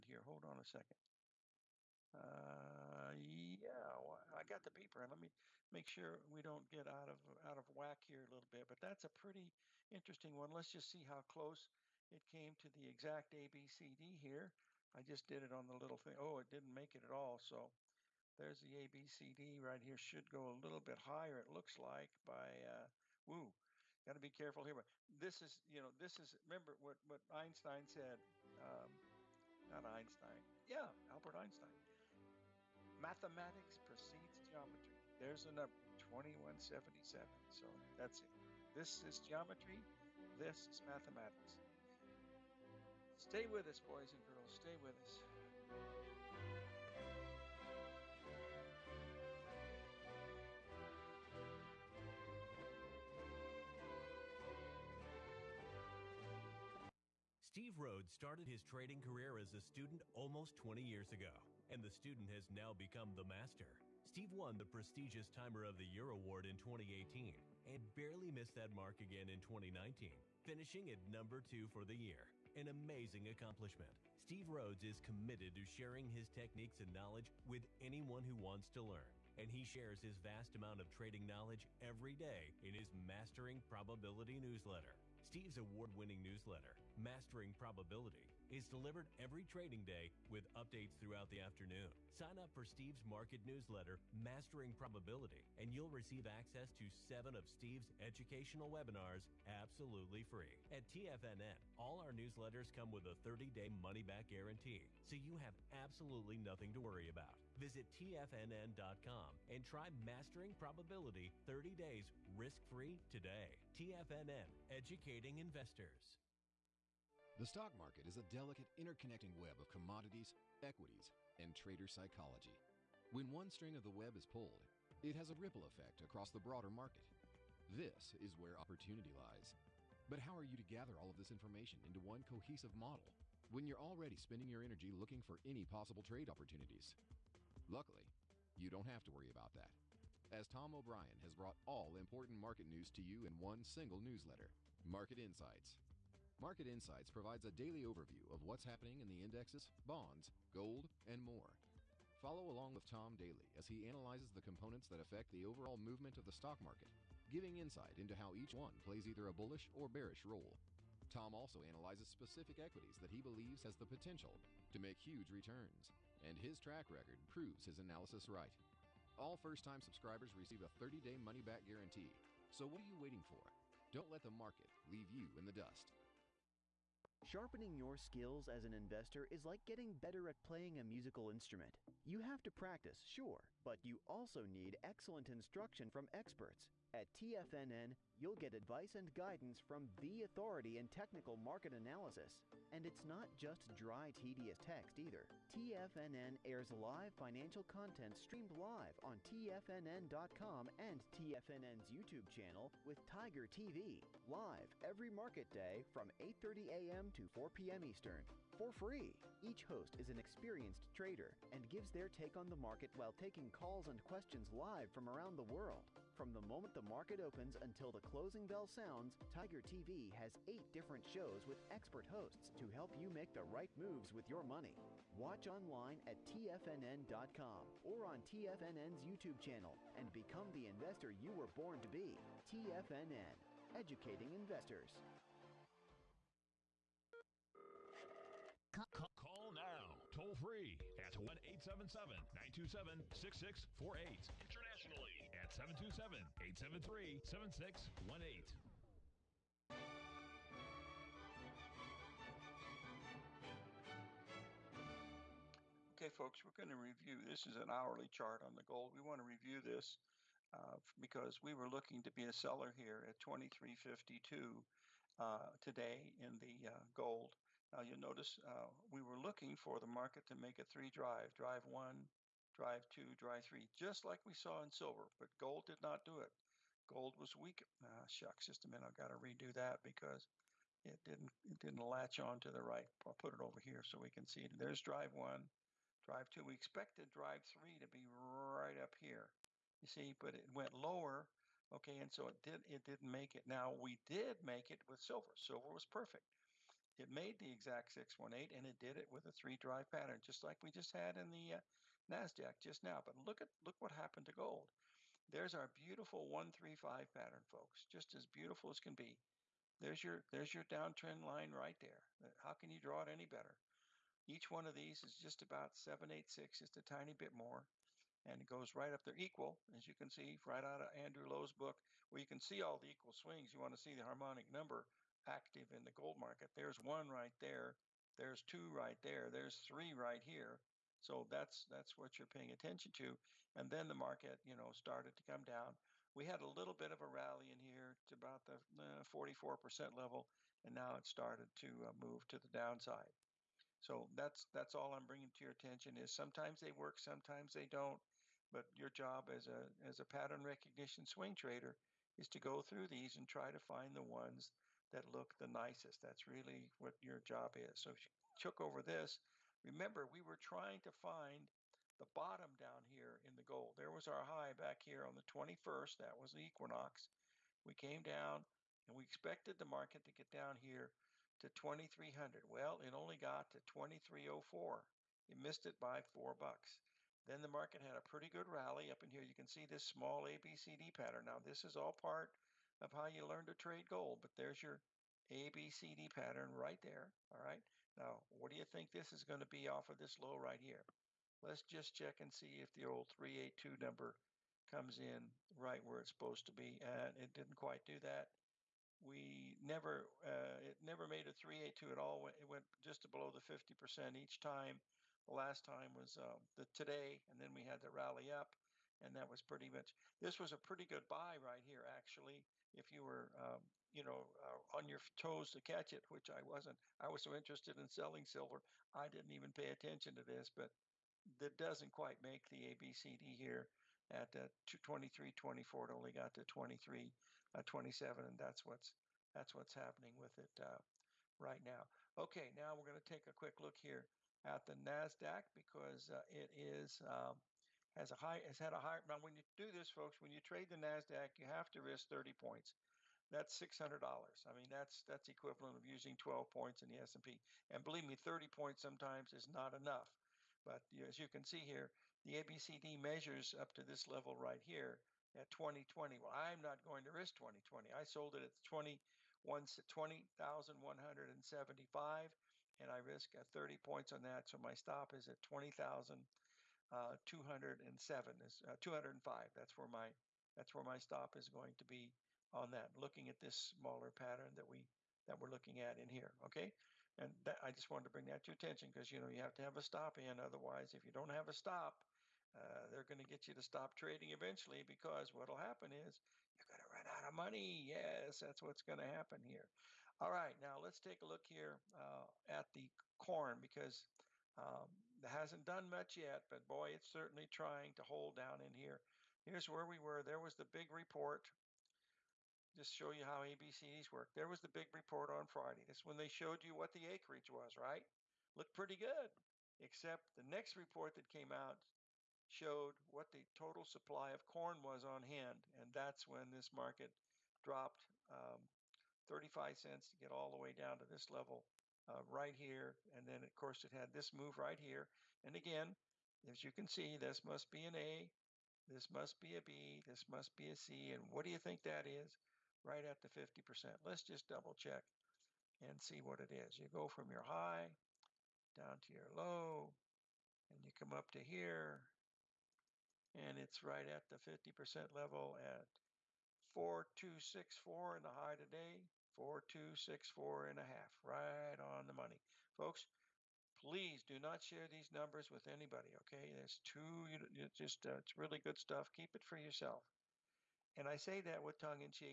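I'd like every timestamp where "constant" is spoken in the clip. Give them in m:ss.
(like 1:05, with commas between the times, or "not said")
not said.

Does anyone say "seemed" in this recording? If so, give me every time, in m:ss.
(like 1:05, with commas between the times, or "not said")
not said.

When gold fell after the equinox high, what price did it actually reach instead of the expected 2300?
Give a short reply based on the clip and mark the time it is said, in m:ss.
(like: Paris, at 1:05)
2304, at 6:13.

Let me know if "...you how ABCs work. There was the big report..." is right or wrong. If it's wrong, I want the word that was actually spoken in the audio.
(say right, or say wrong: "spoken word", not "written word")
right.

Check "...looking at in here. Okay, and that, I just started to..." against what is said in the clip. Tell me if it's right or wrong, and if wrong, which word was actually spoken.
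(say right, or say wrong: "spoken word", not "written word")
wrong: "wanted", not "started".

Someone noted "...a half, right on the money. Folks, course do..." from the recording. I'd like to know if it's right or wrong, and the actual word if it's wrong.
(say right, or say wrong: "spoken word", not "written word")
wrong: "please", not "course".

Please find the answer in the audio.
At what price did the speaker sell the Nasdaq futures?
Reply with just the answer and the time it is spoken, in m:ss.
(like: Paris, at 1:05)
20,175, at 7:38.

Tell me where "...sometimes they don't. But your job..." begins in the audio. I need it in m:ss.
5:46.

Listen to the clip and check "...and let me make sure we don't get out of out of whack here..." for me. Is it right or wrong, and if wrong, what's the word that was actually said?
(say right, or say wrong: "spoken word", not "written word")
right.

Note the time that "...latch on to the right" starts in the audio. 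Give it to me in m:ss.
4:41.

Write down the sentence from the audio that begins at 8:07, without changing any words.
Yes, that's what's going to happen here.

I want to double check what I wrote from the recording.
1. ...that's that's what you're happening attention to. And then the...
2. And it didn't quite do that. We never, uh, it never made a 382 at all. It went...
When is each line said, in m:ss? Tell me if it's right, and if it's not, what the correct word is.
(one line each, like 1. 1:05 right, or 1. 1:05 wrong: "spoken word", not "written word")
1. 5:31 wrong: "paying", not "happening"
2. 6:36 right.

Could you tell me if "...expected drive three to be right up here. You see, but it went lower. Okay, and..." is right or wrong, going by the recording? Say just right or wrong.
right.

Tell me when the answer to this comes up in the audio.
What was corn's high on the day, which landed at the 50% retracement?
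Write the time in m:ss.
9:06.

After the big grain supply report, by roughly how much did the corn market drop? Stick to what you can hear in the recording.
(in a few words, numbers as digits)
35 cents.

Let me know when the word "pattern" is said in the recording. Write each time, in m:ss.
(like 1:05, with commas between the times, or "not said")
4:59, 5:07, 5:50, 6:20, 6:26, 7:54.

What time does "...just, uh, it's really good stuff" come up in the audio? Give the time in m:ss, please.
9:17.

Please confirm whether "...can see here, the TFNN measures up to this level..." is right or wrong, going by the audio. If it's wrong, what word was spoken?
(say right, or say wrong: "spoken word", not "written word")
wrong: "ABCD", not "TFNN".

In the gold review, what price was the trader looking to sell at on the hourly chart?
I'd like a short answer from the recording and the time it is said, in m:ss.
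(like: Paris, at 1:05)
2352, at 4:23.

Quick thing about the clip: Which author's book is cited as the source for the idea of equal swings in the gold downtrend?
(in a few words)
Andrew Lowe.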